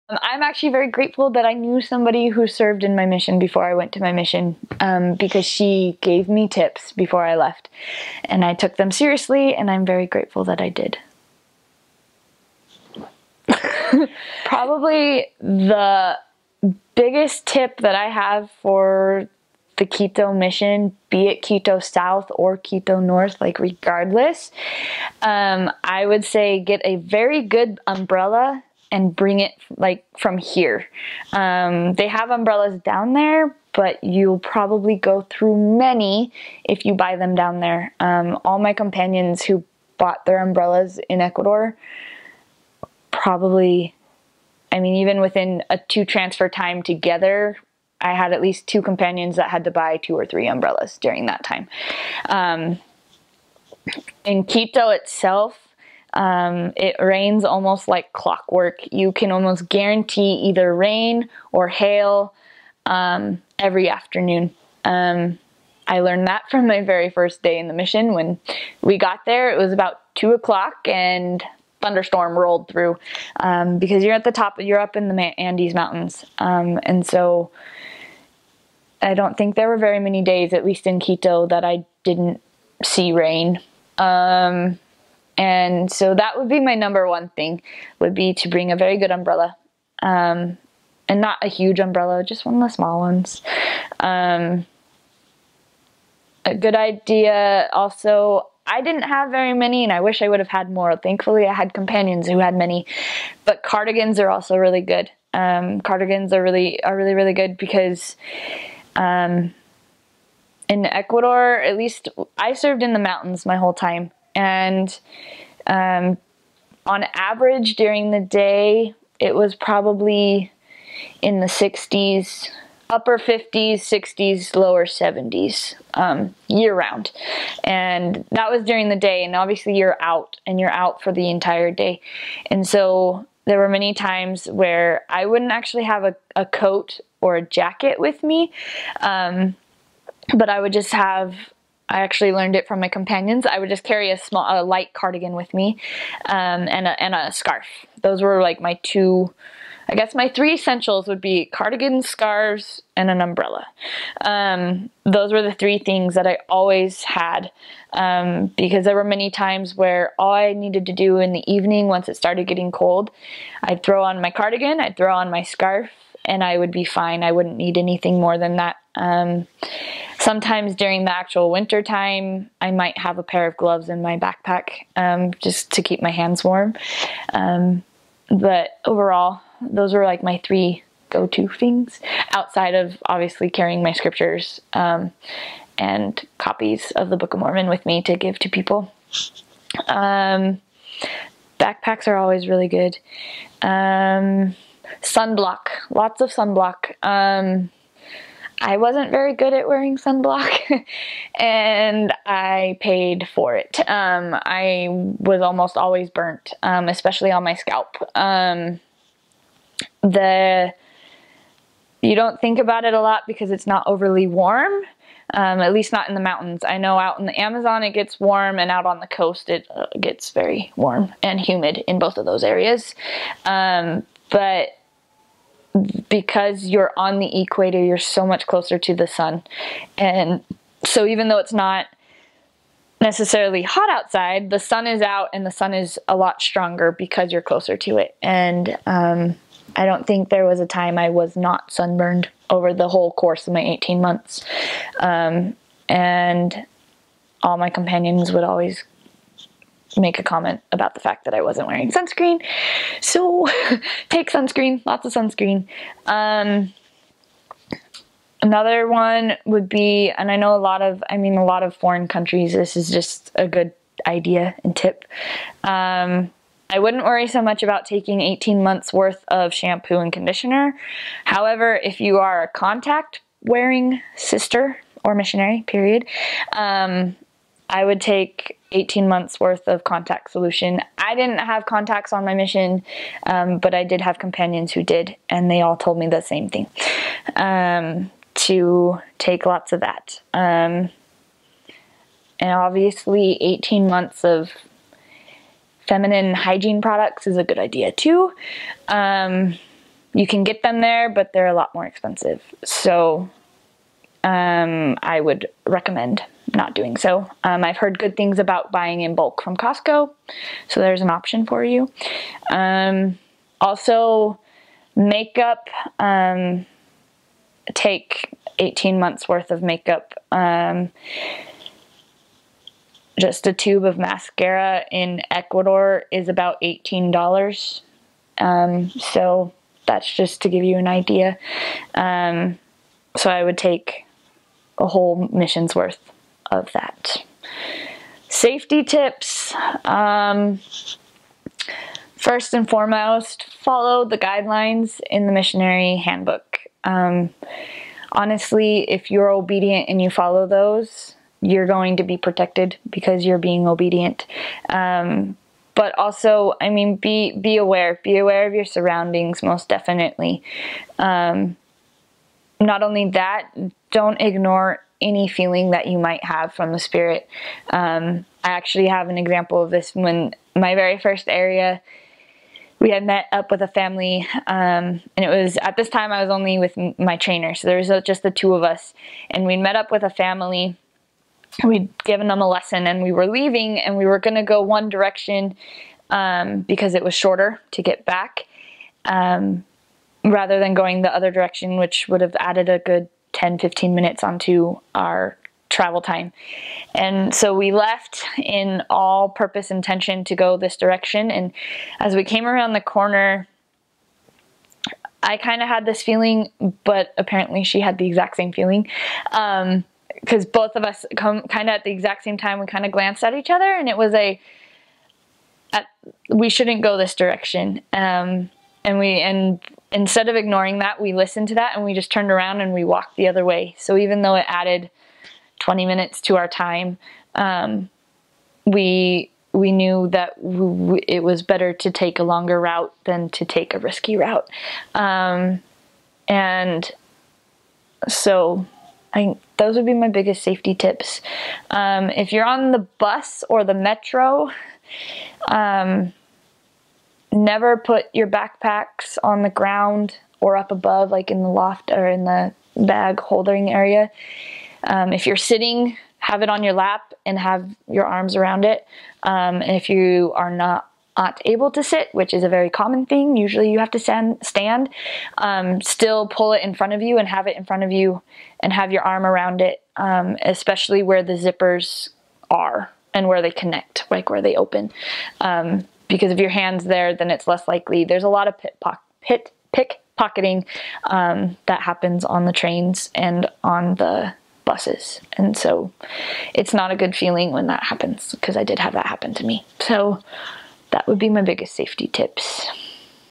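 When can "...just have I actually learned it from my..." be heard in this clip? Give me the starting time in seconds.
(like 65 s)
140 s.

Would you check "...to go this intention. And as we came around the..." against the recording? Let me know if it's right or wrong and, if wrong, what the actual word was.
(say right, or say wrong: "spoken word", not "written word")
wrong: "direction", not "intention".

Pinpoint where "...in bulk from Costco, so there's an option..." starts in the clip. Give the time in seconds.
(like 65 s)
309 s.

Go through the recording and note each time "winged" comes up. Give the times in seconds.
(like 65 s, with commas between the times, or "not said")
not said.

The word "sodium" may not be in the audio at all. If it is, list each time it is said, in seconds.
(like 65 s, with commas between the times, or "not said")
not said.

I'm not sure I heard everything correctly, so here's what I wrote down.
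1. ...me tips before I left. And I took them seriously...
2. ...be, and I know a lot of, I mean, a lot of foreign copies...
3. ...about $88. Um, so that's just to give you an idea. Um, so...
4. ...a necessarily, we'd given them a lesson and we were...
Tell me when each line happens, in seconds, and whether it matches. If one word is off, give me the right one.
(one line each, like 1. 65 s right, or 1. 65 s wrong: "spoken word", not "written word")
1. 6 s right
2. 259 s wrong: "countries", not "copies"
3. 326 s wrong: "18", not "88"
4. 380 s wrong: "family", not "necessarily".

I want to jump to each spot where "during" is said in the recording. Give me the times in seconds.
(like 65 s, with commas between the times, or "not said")
50 s, 117 s, 128 s, 170 s.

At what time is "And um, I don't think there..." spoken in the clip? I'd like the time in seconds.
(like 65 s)
238 s.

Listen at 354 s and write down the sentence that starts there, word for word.
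Um, but also, I mean, be be aware.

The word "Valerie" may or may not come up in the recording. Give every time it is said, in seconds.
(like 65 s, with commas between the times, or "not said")
not said.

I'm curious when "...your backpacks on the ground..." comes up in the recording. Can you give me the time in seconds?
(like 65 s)
448 s.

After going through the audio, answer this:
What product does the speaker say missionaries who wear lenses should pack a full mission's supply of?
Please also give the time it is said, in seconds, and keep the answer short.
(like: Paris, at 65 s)
contact solution, at 279 s.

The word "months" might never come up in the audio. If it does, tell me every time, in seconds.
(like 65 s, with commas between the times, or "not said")
244 s, 268 s, 279 s, 293 s, 318 s.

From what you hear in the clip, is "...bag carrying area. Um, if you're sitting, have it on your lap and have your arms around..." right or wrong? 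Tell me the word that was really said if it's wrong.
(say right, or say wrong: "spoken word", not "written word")
wrong: "holding", not "carrying".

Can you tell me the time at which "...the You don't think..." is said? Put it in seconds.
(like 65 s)
210 s.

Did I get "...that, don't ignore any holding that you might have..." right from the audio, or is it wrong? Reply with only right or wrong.
wrong.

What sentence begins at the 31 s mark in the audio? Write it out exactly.
Um, they have umbrellas down there, but you'll probably go through many if you buy them down there.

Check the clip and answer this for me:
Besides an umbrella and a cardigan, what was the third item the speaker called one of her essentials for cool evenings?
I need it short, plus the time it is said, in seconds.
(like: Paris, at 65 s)
scarves, at 152 s.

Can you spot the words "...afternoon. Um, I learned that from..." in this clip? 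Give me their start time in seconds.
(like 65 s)
63 s.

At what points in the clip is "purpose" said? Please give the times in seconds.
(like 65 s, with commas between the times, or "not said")
399 s.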